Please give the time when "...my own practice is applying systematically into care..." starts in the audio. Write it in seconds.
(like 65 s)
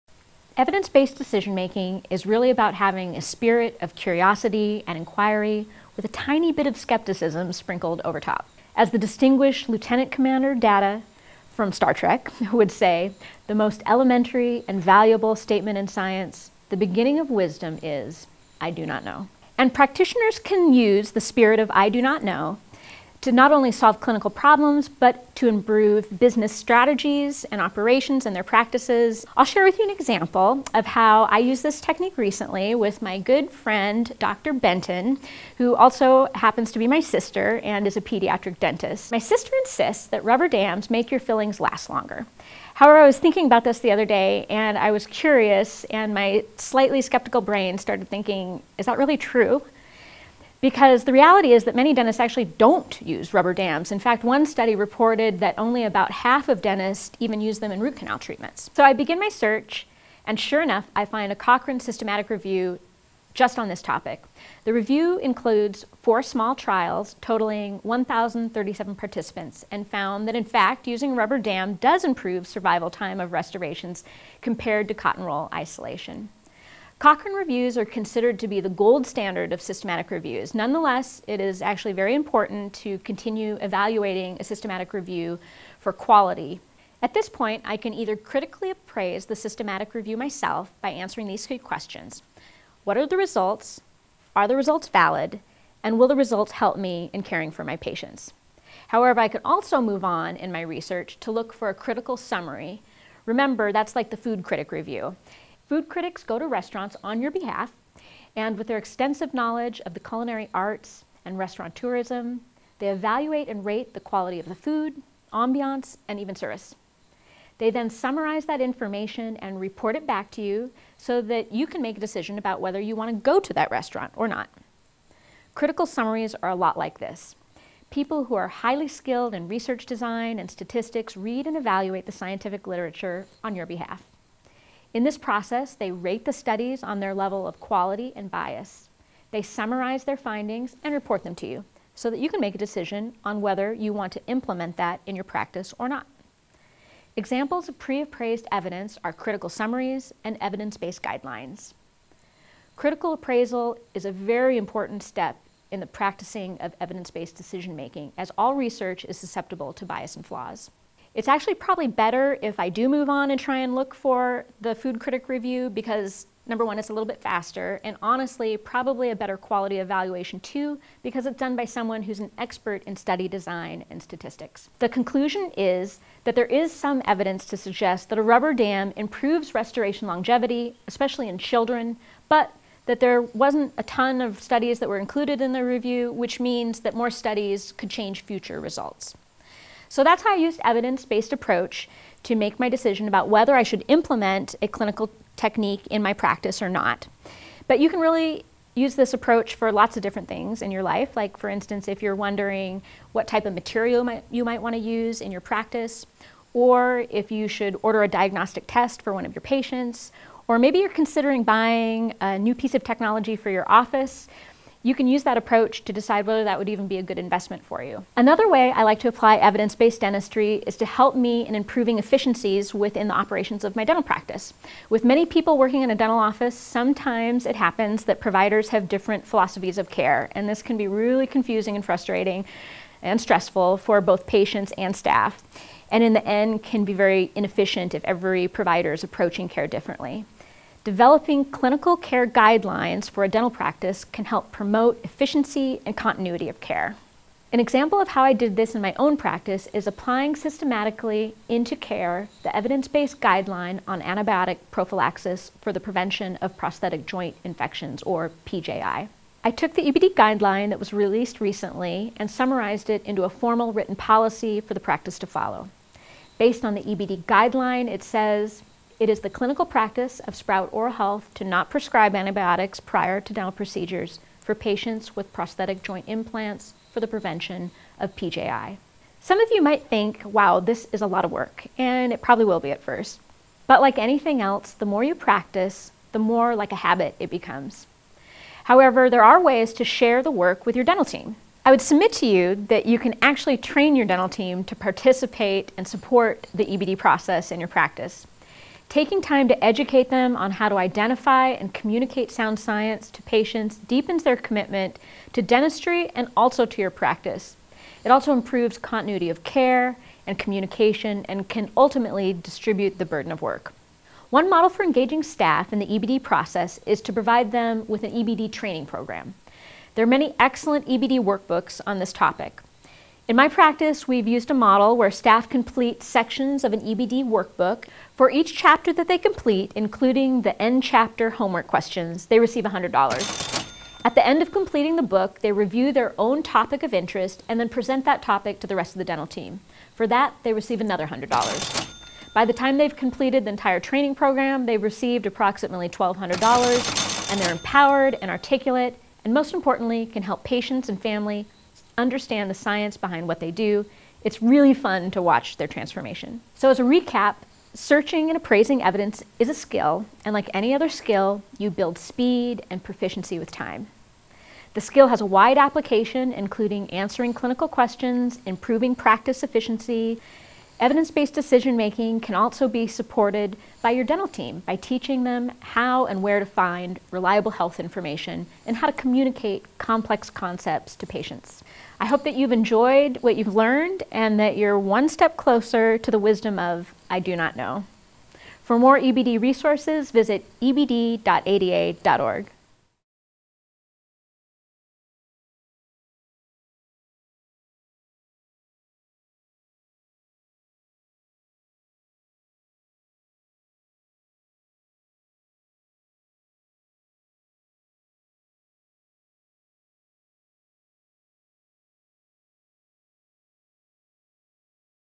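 248 s.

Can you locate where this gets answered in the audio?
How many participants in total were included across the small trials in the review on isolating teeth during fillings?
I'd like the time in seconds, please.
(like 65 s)
67 s.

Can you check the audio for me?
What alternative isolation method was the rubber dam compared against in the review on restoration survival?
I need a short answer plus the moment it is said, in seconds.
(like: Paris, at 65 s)
cotton roll isolation, at 74 s.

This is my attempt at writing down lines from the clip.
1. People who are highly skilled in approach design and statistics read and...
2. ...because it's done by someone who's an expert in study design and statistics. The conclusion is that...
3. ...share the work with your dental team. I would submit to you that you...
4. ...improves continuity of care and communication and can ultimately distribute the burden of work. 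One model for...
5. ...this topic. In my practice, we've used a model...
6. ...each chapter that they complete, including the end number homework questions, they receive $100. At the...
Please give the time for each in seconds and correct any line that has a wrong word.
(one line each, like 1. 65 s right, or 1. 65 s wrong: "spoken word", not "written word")
1. 127 s wrong: "research", not "approach"
2. 171 s right
3. 289 s right
4. 308 s right
5. 321 s right
6. 328 s wrong: "chapter", not "number".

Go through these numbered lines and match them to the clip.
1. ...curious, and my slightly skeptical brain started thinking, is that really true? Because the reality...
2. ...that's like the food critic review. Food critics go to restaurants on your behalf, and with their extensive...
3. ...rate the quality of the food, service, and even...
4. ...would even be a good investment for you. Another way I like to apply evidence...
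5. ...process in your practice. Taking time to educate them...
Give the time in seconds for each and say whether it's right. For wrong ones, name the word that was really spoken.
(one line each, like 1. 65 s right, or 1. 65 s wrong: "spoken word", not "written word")
1. 45 s right
2. 103 s right
3. 113 s wrong: "ambiance", not "service"
4. 216 s right
5. 296 s right.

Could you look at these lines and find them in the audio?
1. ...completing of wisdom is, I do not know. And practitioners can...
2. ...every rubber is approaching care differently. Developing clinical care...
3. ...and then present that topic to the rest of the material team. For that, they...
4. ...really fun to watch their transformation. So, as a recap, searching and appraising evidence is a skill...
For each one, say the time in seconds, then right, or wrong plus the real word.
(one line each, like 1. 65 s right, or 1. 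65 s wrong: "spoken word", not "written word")
1. 16 s wrong: "beginning", not "completing"
2. 238 s wrong: "provider", not "rubber"
3. 337 s wrong: "dental", not "material"
4. 354 s right.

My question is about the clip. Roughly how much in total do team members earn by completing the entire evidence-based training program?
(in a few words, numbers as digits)
$1,200.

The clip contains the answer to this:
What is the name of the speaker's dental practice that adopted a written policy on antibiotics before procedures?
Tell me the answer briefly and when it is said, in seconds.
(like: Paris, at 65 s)
Sprout Oral Health, at 270 s.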